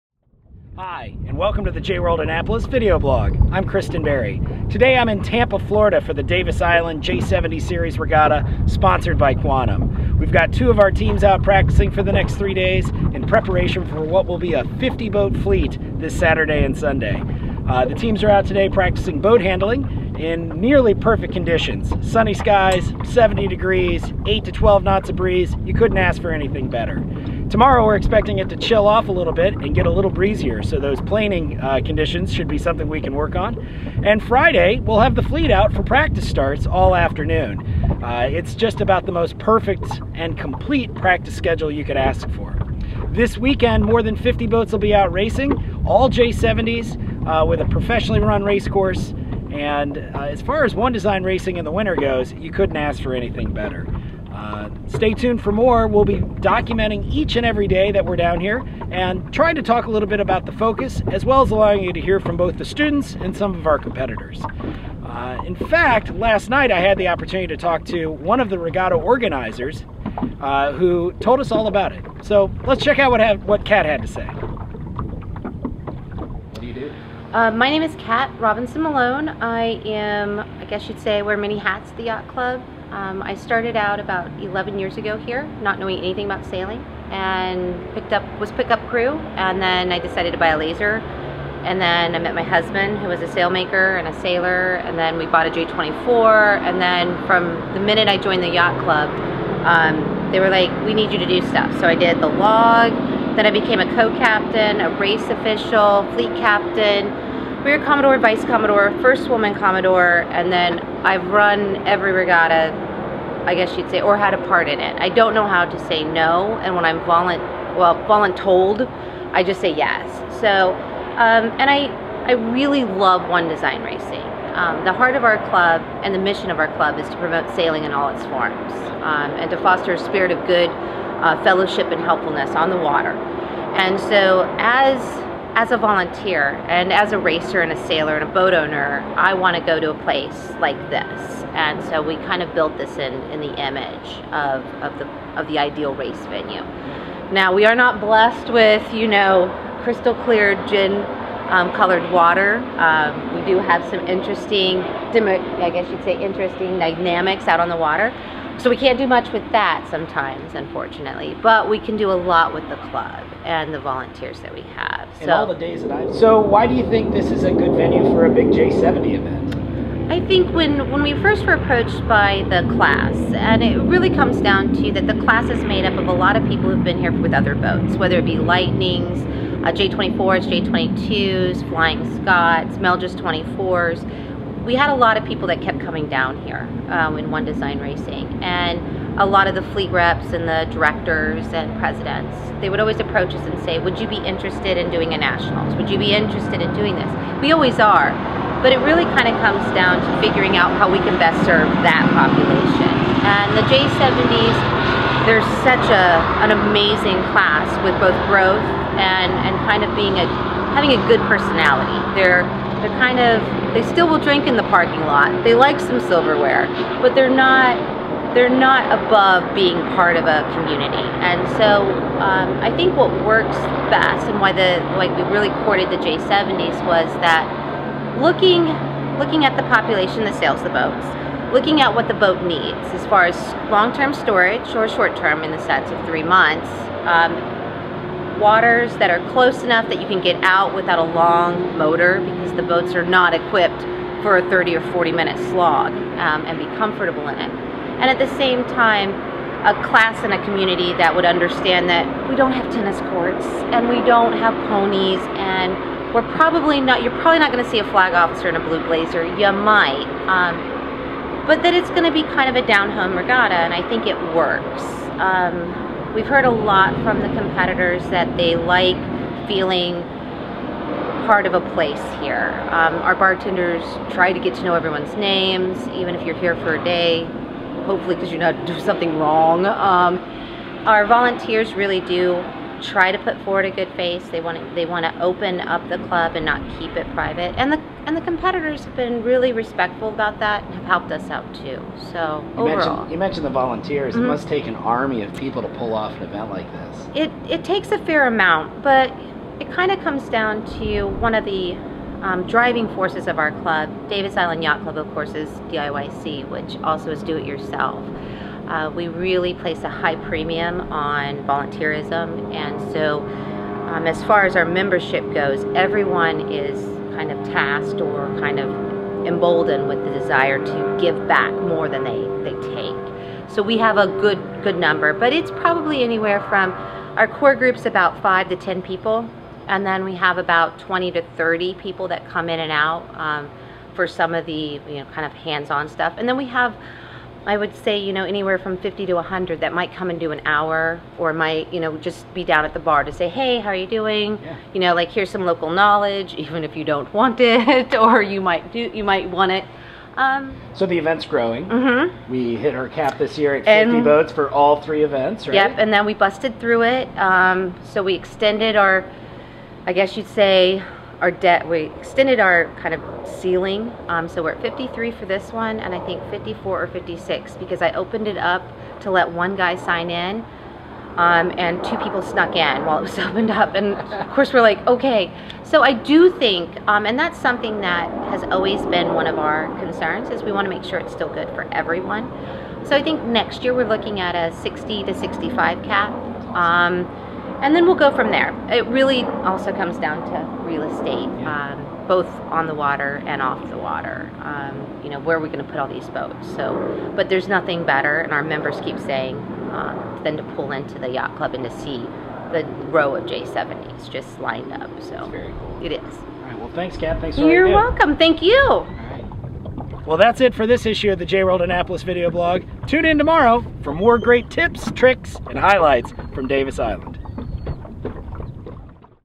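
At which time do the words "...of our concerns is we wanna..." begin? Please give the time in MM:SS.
06:19.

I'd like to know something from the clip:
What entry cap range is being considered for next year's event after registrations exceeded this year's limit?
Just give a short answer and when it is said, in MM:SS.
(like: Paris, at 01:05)
60 to 65, at 06:24.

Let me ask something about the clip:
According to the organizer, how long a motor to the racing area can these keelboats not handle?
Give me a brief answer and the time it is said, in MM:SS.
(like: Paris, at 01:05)
30 or 40 minutes, at 04:04.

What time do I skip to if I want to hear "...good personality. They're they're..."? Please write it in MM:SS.
03:31.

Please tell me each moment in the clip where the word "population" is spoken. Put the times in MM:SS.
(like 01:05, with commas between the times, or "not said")
03:22, 03:49.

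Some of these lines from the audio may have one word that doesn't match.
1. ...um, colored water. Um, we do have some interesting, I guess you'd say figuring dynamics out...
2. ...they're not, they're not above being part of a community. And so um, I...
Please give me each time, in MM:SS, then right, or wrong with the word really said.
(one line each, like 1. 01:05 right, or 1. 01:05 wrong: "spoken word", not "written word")
1. 02:31 wrong: "interesting", not "figuring"
2. 03:37 right.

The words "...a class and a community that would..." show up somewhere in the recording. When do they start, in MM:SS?
04:09.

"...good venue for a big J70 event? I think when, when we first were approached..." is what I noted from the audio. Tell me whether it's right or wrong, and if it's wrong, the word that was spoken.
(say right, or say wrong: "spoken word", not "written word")
right.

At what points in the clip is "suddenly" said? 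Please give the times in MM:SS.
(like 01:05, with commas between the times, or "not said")
not said.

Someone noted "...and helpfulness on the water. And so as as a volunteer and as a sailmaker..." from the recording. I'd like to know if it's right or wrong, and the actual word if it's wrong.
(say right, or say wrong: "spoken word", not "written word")
wrong: "racer", not "sailmaker".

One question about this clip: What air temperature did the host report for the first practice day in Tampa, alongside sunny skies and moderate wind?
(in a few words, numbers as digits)
70 degrees.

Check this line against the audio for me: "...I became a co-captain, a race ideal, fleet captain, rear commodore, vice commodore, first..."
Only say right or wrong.
wrong.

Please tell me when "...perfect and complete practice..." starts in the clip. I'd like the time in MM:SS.
00:39.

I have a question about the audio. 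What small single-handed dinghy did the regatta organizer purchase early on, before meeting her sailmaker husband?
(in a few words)
Laser.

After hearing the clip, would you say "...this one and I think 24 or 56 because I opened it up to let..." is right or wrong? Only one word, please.
wrong.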